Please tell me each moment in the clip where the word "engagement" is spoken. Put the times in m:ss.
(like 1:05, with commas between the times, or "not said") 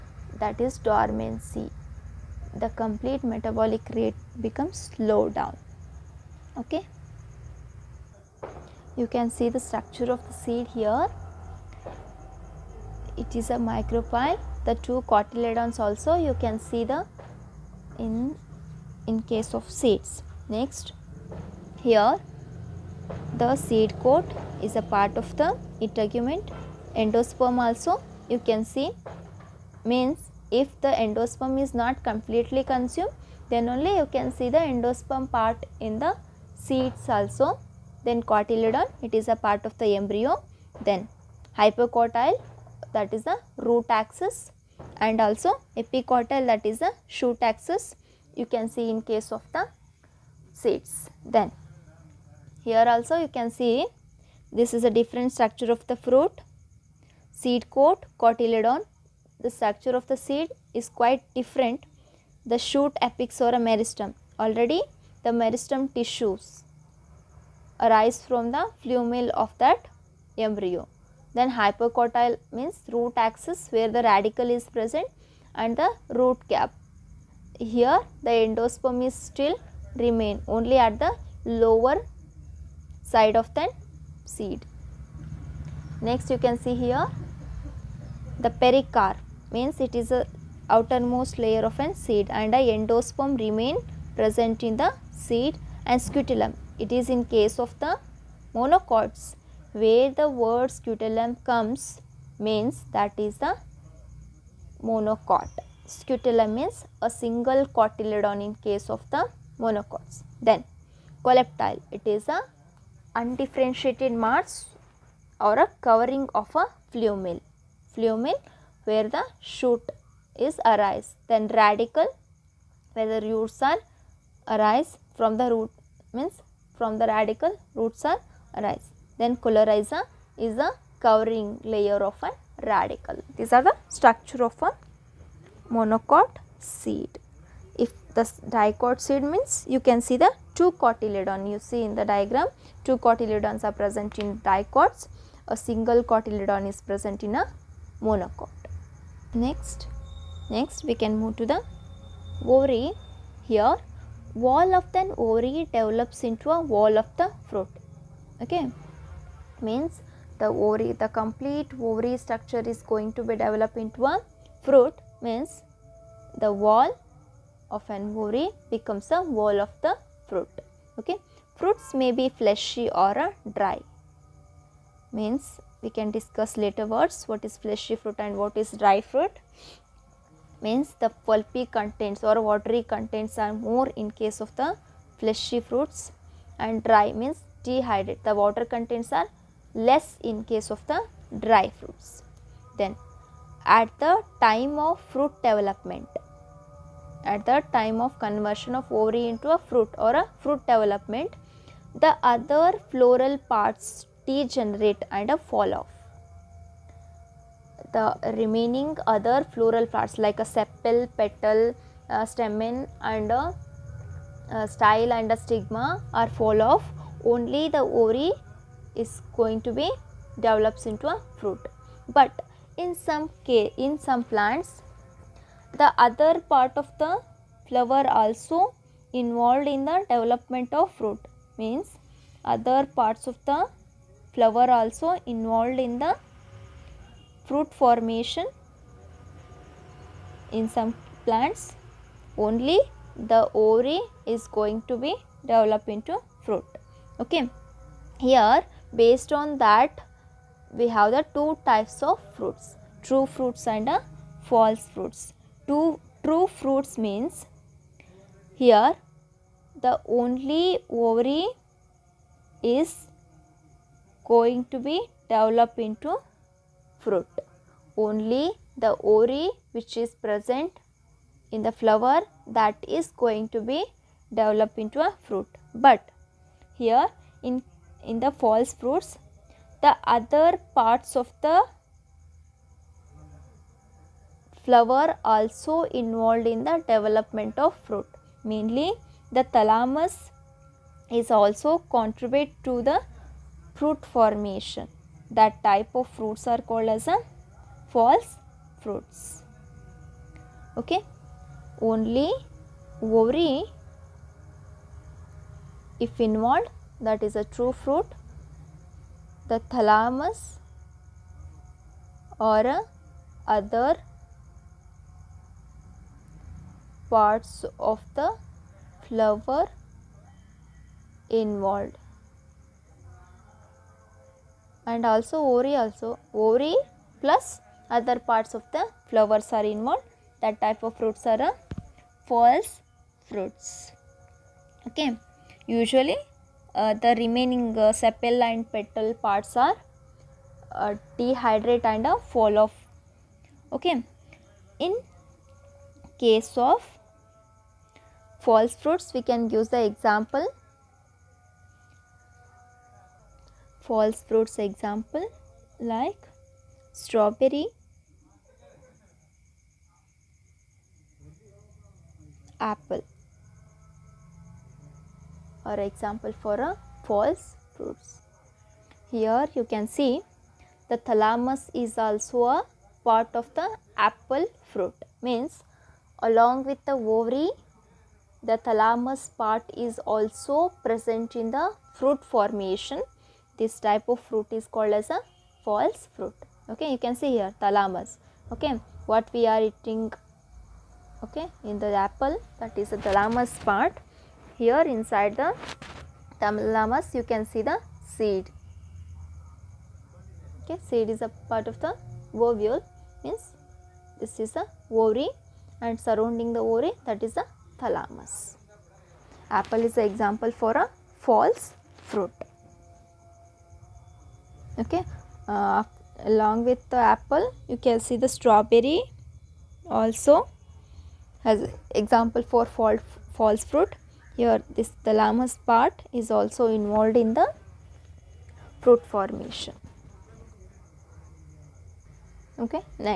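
not said.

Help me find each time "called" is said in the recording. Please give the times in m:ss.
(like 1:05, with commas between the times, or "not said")
4:56, 6:24.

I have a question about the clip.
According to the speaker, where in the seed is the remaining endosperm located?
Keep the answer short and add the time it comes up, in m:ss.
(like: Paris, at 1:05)
Lower side of the seed, at 1:21.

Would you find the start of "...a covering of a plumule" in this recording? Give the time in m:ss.
1:55.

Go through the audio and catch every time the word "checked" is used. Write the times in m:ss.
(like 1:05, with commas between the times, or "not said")
not said.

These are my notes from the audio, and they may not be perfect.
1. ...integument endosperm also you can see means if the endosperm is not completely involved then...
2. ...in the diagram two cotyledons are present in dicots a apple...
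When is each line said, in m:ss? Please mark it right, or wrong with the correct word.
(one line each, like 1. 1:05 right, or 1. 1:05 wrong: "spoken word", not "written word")
1. 0:25 wrong: "consumed", not "involved"
2. 2:21 wrong: "single", not "apple".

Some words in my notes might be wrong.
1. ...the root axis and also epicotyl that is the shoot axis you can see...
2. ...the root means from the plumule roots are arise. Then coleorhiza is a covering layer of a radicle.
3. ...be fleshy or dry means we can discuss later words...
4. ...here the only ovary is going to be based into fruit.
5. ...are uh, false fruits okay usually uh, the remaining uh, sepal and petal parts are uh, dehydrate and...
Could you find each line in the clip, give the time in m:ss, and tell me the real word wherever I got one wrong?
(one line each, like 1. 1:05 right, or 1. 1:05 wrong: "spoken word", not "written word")
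1. 0:43 right
2. 2:05 wrong: "radicle", not "plumule"
3. 2:52 right
4. 4:18 wrong: "developed", not "based"
5. 5:31 right.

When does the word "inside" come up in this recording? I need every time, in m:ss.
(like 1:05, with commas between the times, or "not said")
6:34.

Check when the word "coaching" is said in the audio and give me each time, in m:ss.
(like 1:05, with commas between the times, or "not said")
not said.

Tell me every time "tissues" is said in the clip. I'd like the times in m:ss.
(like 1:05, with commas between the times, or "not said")
1:05.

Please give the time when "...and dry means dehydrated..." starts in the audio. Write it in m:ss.
3:06.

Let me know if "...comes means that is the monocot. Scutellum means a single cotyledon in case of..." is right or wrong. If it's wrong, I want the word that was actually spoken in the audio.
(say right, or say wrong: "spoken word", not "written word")
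right.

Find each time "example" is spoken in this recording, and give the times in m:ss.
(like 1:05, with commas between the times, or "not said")
5:49, 5:54, 6:05, 6:50, 7:01.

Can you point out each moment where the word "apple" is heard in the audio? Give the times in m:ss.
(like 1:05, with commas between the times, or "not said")
6:02, 6:14, 6:32, 6:49, 6:56.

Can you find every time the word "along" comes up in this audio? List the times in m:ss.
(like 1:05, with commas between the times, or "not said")
6:16, 6:56.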